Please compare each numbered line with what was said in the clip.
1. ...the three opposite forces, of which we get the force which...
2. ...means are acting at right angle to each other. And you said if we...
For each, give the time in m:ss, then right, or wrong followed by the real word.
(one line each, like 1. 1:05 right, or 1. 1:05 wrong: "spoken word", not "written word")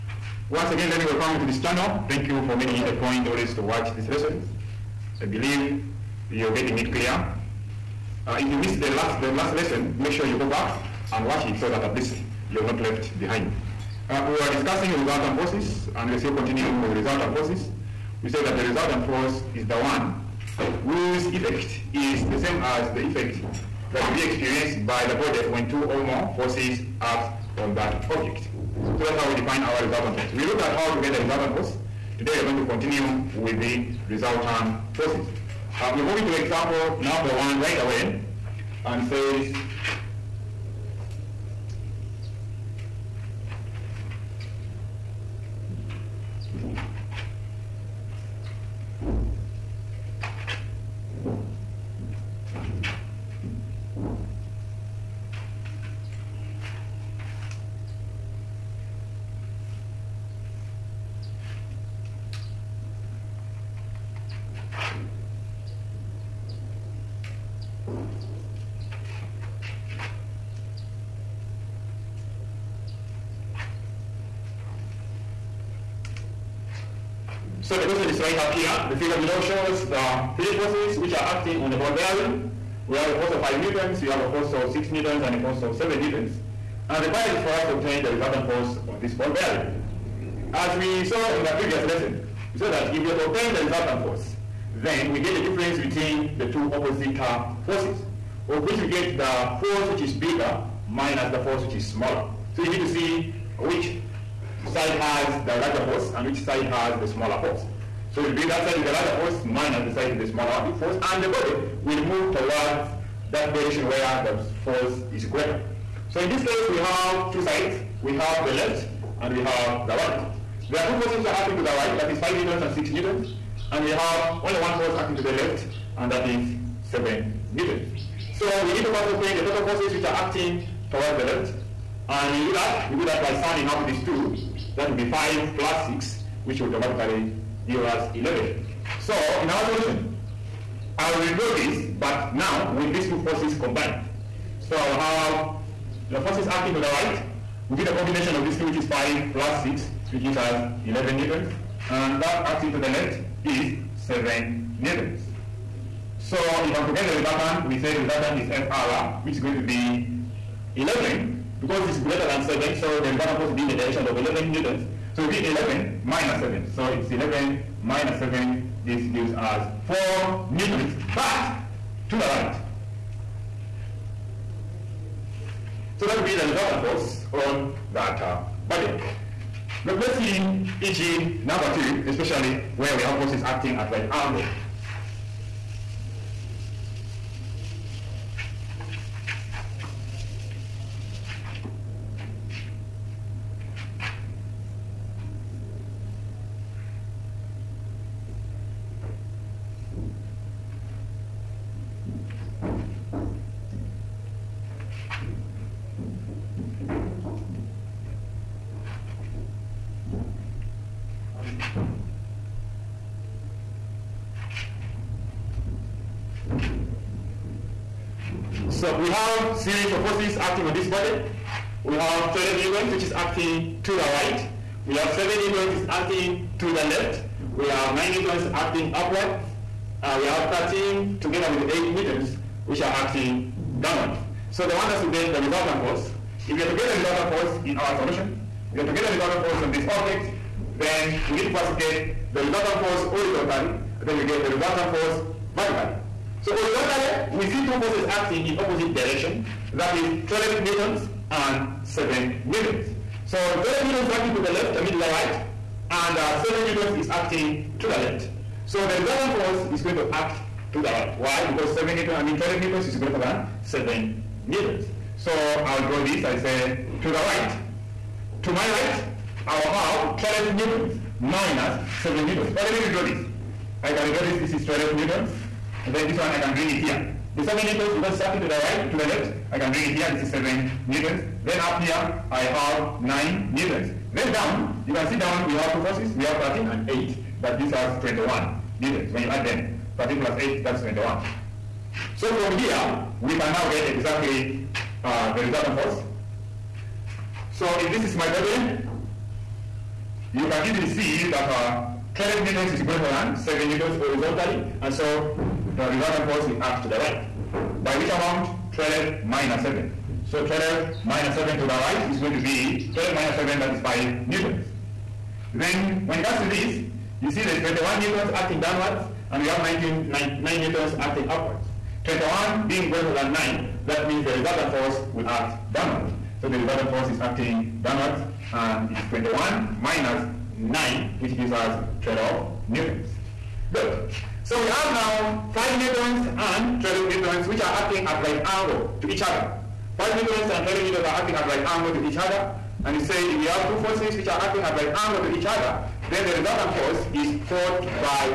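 1. 1:36 wrong: "two", not "three"
2. 5:40 wrong: "newtons", not "means".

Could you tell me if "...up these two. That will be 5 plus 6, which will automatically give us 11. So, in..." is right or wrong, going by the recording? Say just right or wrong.
right.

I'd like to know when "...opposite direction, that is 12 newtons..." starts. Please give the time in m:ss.
4:08.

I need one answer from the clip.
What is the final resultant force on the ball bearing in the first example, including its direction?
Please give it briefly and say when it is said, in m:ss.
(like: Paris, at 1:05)
4 newtons to the right, at 2:49.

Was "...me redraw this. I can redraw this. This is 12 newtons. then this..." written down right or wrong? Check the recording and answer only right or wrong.
right.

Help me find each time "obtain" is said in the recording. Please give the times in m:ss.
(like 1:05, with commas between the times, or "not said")
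1:27, 1:33, 2:09.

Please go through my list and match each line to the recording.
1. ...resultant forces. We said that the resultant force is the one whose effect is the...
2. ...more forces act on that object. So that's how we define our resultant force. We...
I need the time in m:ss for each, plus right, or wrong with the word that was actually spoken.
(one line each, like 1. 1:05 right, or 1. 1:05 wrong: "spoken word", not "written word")
1. 0:16 right
2. 0:26 right.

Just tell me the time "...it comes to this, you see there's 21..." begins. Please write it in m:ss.
5:16.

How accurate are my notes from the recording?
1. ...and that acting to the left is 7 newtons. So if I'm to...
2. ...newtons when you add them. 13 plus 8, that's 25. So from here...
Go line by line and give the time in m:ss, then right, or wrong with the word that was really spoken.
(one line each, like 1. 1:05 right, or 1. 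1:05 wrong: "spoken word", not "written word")
1. 2:31 right
2. 4:48 wrong: "21", not "25".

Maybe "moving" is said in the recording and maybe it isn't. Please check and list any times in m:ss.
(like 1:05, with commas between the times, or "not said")
0:36.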